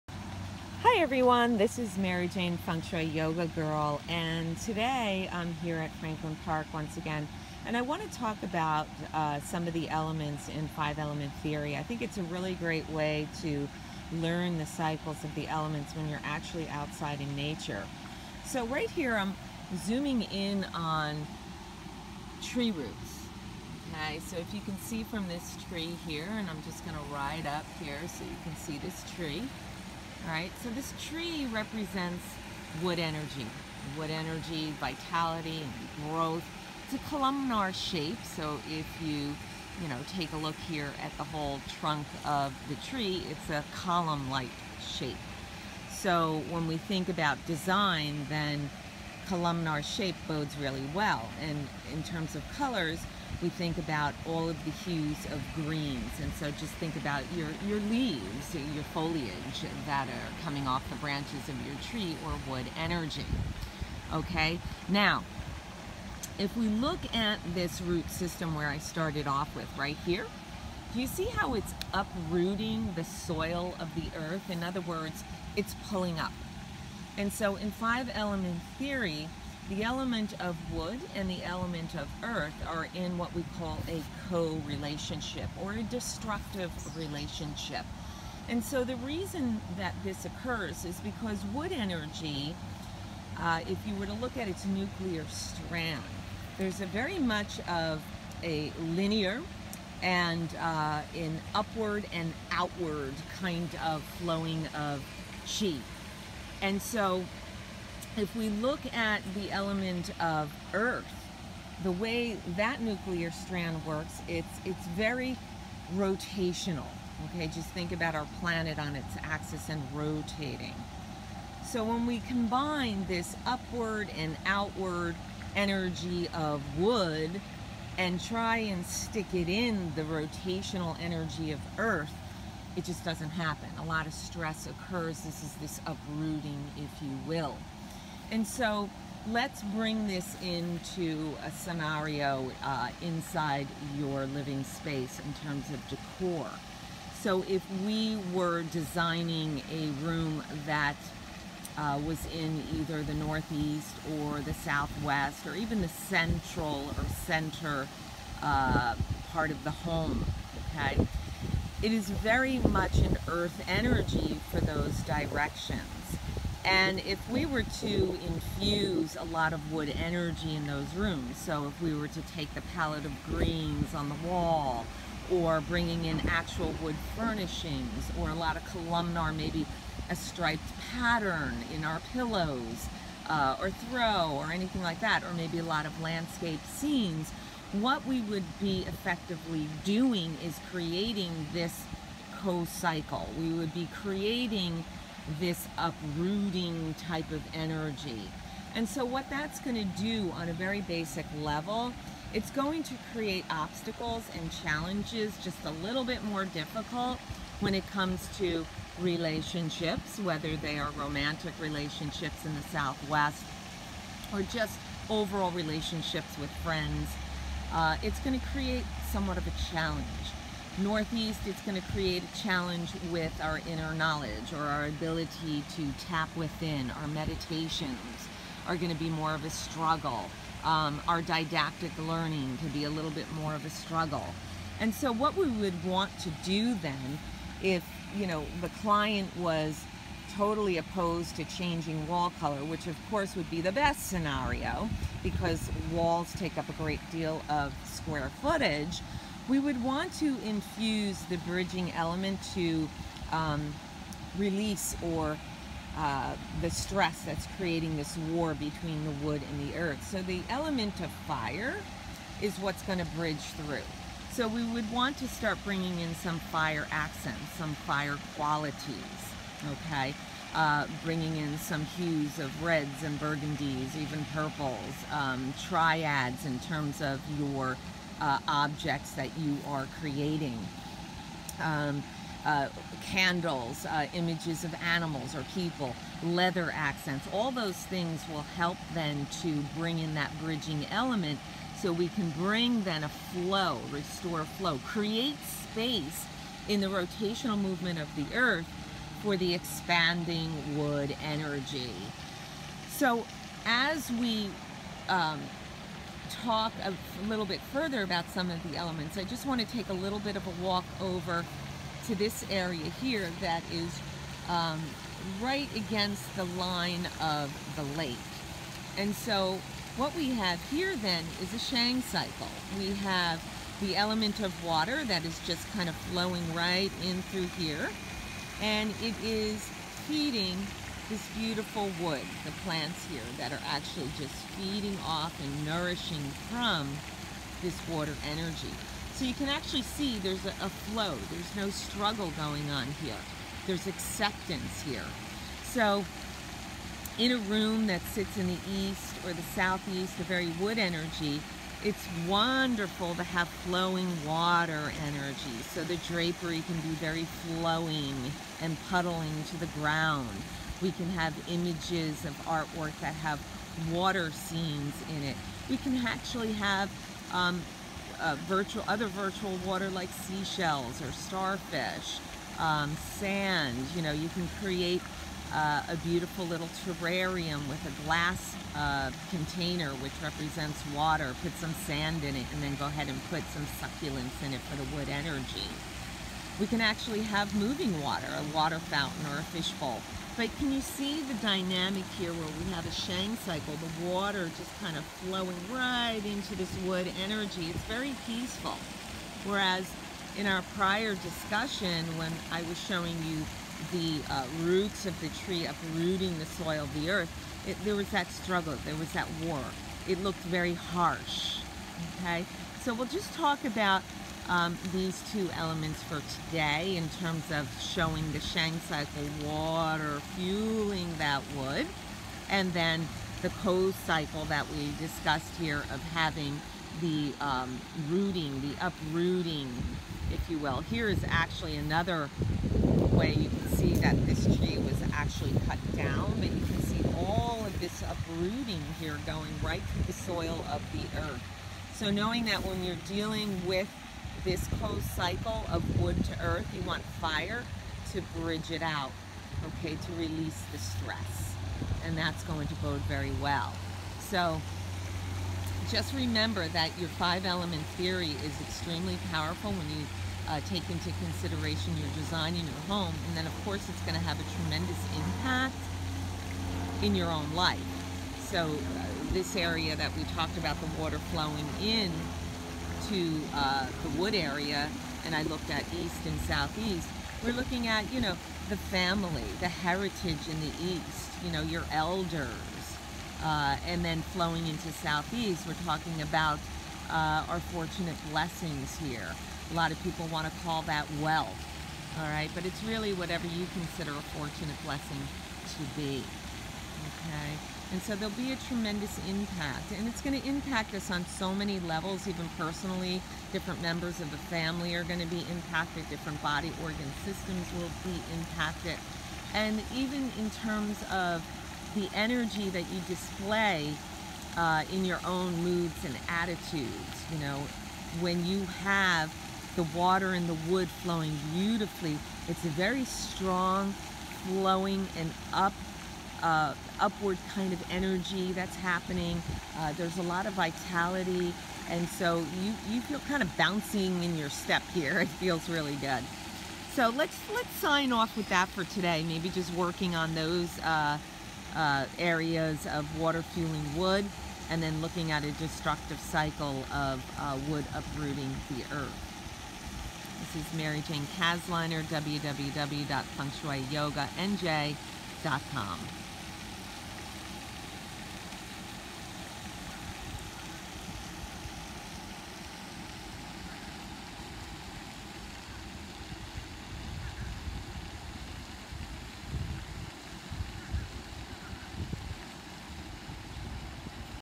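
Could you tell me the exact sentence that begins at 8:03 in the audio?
Uh, and then flowing into southeast, we're talking about uh, our fortunate blessings here.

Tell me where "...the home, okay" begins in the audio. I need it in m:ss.
2:39.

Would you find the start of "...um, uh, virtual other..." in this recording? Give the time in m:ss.
6:07.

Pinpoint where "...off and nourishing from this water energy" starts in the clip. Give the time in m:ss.
5:35.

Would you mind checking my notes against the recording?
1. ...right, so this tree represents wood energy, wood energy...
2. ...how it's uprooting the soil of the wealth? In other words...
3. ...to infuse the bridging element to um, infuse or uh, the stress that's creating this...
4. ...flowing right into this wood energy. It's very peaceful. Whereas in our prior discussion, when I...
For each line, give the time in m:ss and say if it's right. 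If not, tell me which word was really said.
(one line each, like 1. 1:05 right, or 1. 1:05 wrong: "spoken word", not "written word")
1. 0:30 right
2. 1:11 wrong: "earth", not "wealth"
3. 4:10 wrong: "release", not "infuse"
4. 6:35 right.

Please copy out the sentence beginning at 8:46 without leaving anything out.
Uh, upward kind of energy that's happening.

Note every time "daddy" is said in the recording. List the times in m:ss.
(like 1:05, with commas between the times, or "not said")
not said.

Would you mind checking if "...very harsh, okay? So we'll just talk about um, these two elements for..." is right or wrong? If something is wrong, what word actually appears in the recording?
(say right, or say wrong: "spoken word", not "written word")
right.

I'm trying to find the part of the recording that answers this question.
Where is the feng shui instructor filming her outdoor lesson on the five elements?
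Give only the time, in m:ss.
0:05.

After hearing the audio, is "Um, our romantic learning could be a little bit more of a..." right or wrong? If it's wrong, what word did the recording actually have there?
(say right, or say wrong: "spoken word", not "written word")
wrong: "didactic", not "romantic".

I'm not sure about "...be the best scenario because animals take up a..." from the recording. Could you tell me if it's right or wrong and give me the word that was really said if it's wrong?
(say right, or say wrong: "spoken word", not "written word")
wrong: "walls", not "animals".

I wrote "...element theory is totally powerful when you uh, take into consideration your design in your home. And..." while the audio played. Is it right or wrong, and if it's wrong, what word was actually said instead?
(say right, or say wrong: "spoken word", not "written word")
wrong: "extremely", not "totally".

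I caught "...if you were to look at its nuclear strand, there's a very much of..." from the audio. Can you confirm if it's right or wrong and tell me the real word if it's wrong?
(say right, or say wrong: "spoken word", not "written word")
right.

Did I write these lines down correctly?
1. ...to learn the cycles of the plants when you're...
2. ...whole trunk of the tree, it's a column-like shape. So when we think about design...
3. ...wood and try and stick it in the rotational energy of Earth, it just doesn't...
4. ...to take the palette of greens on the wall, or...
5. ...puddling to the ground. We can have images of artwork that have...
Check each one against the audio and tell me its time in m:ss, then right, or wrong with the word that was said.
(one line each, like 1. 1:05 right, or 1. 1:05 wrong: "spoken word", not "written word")
1. 0:13 wrong: "elements", not "plants"
2. 0:41 right
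3. 2:06 right
4. 2:52 right
5. 5:58 right.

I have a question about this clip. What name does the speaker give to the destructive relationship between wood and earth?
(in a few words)
Ko-relationship.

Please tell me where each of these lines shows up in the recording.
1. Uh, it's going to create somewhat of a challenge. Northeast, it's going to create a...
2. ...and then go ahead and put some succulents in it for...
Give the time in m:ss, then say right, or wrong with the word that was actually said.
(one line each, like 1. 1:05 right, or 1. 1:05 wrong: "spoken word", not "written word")
1. 3:37 right
2. 6:22 right.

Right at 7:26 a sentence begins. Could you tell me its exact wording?
You want fire to bridge it out, okay, to release the stress.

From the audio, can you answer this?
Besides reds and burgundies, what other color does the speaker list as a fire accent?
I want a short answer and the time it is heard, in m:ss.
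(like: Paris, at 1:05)
Purples, at 4:34.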